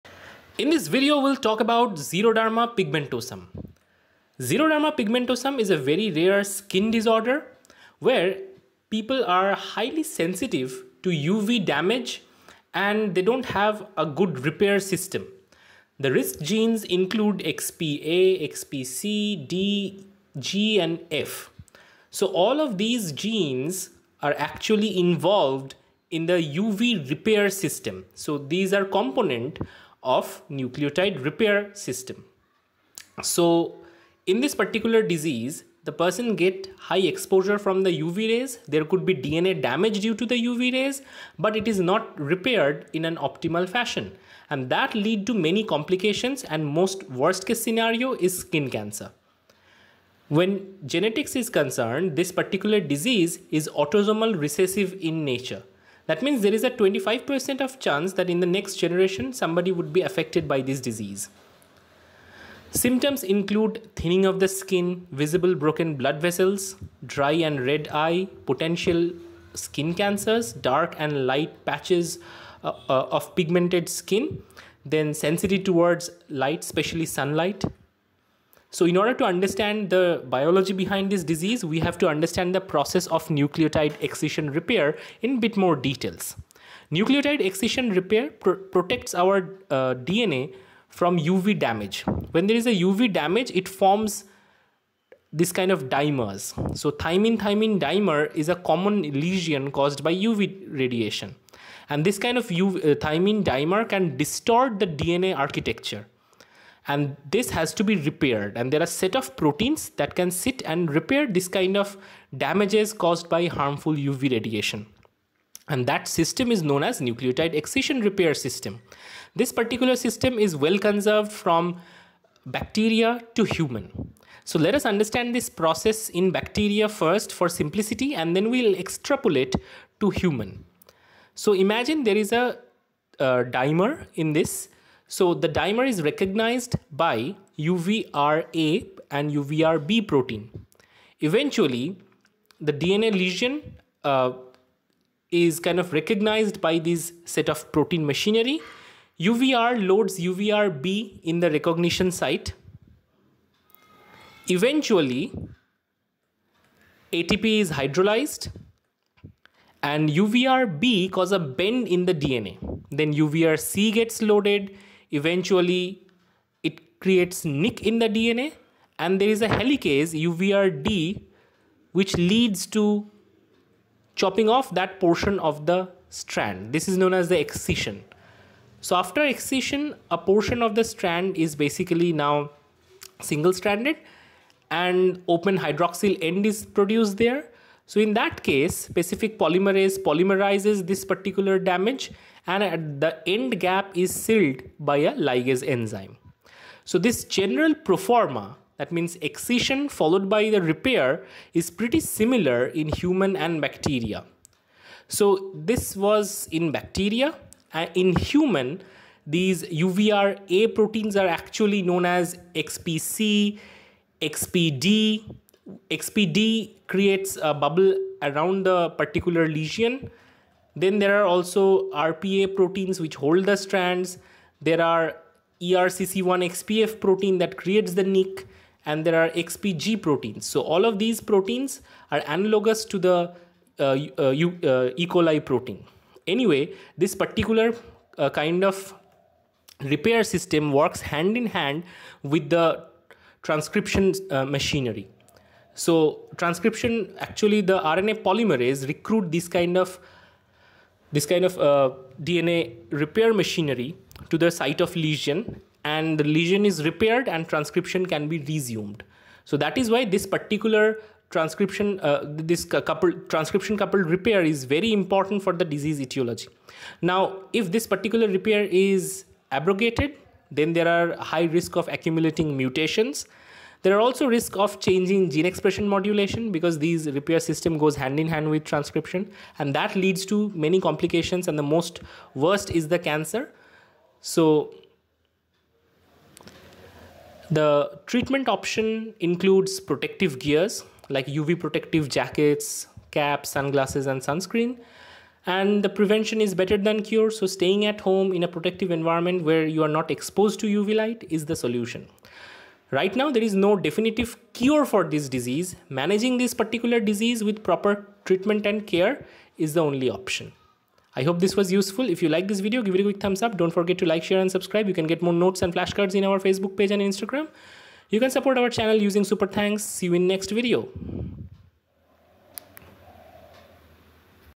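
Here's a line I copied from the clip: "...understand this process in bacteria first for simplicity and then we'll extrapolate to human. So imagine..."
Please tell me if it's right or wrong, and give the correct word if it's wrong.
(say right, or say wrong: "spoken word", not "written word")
right.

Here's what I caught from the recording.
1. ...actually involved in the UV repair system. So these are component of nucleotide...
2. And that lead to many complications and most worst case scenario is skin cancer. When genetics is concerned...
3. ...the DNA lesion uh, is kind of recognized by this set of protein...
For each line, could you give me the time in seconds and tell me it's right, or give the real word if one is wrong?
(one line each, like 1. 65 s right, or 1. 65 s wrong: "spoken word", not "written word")
1. 24 s right
2. 44 s right
3. 142 s right.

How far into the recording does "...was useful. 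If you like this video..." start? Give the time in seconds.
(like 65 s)
311 s.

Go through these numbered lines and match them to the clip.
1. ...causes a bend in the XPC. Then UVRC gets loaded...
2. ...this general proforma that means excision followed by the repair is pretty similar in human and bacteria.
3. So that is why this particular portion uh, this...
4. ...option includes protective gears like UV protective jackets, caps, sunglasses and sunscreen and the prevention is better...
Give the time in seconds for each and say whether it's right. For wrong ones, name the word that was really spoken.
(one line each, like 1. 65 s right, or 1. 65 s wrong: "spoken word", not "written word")
1. 161 s wrong: "DNA", not "XPC"
2. 196 s right
3. 259 s wrong: "transcription", not "portion"
4. 288 s right.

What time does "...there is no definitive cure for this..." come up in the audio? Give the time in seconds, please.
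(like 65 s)
303 s.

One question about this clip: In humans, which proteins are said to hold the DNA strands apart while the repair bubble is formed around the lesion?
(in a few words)
RPA proteins.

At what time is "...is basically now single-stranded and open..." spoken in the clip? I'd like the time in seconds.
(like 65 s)
181 s.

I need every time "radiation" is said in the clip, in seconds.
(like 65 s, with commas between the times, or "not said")
100 s, 114 s.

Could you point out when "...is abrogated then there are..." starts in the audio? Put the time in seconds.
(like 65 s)
268 s.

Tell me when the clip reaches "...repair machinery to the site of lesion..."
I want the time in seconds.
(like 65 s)
252 s.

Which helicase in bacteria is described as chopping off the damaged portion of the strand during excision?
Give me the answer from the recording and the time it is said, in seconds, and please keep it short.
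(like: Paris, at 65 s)
UVRD, at 170 s.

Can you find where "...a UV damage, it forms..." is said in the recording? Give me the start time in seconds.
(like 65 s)
92 s.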